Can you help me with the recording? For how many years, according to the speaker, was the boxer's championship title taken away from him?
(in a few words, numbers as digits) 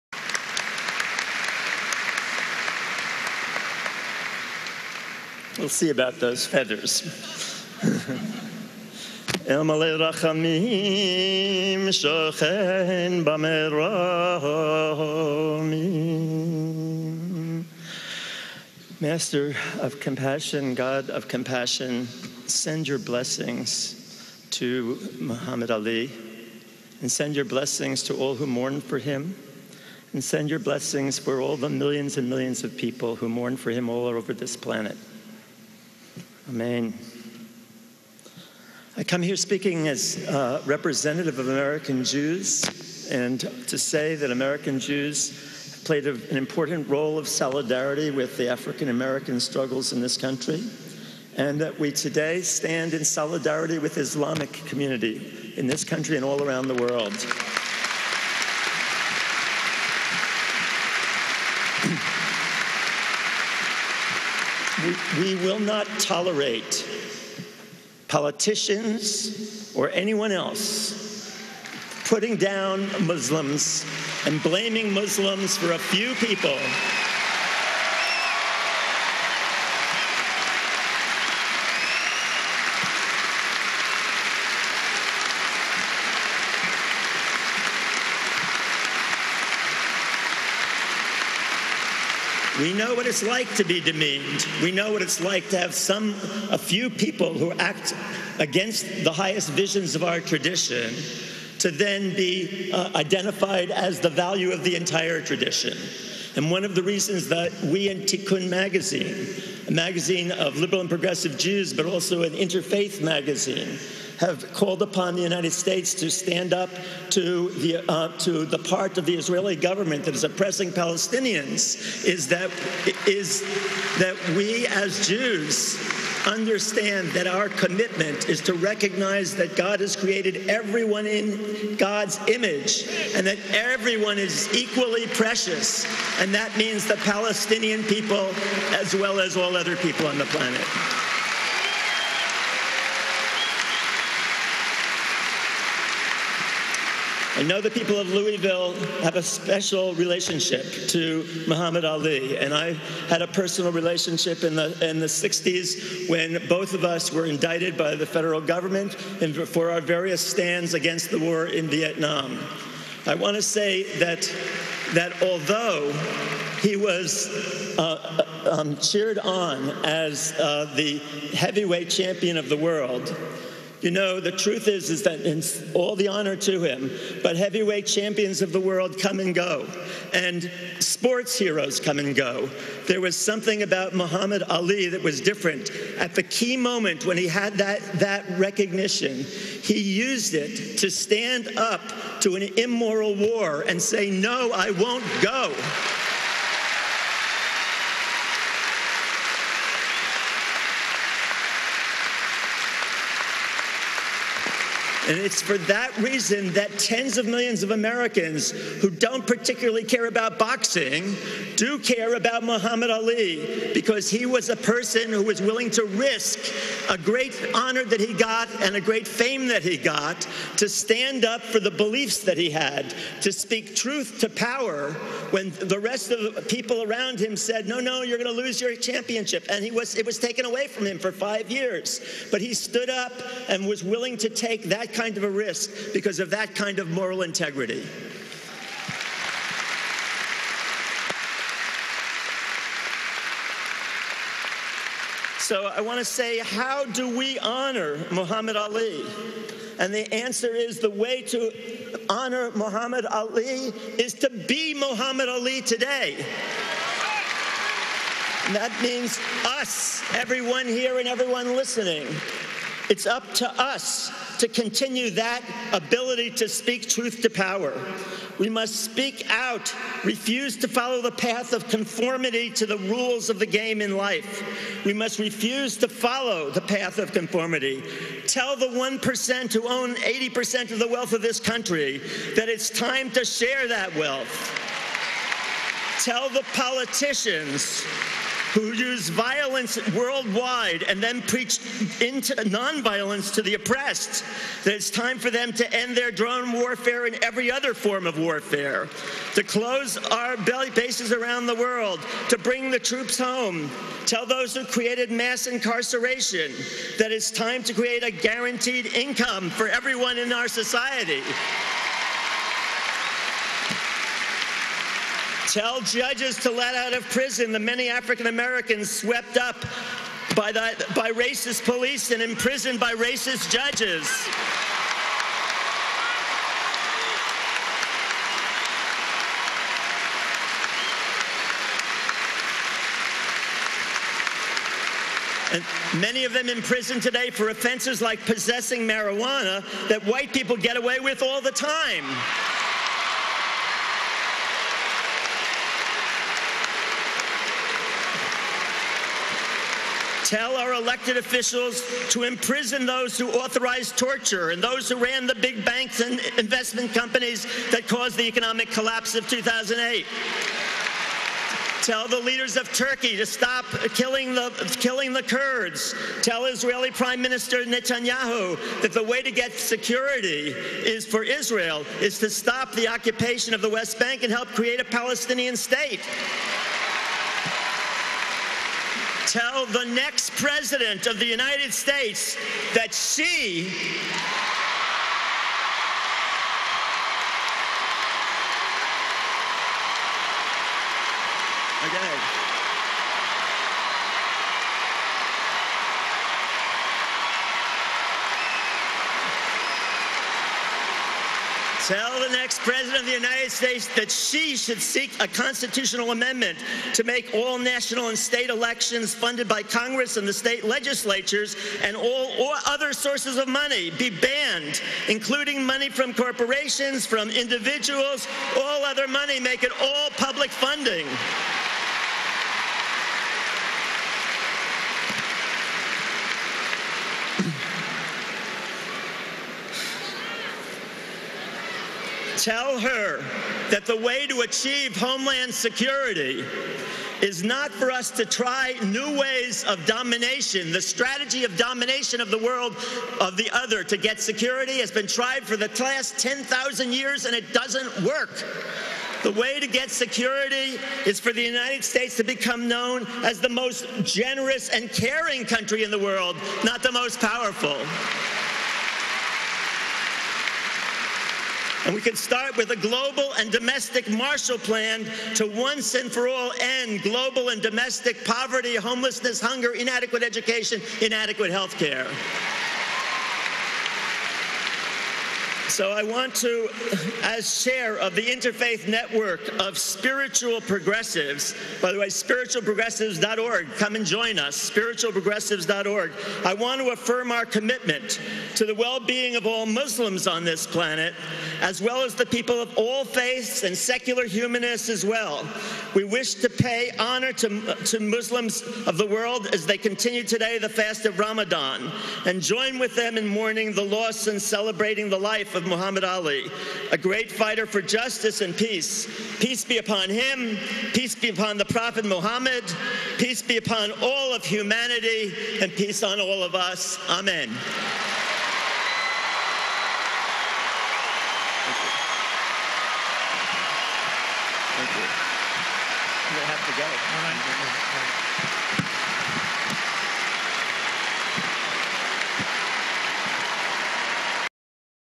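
5.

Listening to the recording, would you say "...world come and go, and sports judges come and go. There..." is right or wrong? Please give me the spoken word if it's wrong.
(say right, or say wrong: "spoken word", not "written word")
wrong: "heroes", not "judges".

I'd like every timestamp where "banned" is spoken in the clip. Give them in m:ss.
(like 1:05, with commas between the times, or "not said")
6:54.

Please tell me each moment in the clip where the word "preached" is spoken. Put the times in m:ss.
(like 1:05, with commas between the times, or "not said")
4:51.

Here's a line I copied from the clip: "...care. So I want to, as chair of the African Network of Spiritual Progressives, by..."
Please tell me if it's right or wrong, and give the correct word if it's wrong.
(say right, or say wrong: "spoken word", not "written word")
wrong: "Interfaith", not "African".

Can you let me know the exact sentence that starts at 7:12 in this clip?
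tell her that the way to achieve homeland security is not for us to try new ways of domination.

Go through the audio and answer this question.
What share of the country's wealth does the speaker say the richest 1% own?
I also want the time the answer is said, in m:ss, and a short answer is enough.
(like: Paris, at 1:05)
80%, at 4:39.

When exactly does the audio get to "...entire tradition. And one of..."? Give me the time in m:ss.
1:44.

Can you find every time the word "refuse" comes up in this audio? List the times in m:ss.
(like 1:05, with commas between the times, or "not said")
4:30, 4:35.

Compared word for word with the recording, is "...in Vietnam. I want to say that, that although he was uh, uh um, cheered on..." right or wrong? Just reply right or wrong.
right.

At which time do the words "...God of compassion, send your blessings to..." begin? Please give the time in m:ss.
0:20.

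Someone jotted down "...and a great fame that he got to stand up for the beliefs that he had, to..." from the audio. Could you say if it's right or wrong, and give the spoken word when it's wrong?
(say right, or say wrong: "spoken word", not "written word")
right.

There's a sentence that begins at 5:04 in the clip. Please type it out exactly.
Tell those who created mass incarceration that it's time to create a guaranteed income for everyone in our society.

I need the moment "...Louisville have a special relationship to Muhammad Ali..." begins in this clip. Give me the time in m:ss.
2:28.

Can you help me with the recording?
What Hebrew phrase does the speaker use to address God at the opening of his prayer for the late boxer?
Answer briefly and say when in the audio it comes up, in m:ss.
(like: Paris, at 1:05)
Rachamim Shochen, at 0:09.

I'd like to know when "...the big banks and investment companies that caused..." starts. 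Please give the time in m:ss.
5:55.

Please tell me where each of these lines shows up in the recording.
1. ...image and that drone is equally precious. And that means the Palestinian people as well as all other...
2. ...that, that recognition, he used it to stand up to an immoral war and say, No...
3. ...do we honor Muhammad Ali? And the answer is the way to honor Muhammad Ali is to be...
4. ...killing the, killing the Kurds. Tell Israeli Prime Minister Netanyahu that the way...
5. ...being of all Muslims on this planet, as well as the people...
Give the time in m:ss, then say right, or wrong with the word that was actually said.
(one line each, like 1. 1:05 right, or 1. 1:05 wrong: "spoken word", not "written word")
1. 2:12 wrong: "everyone", not "drone"
2. 3:07 right
3. 4:06 right
4. 6:03 right
5. 8:08 right.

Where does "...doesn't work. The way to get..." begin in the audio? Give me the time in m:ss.
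7:27.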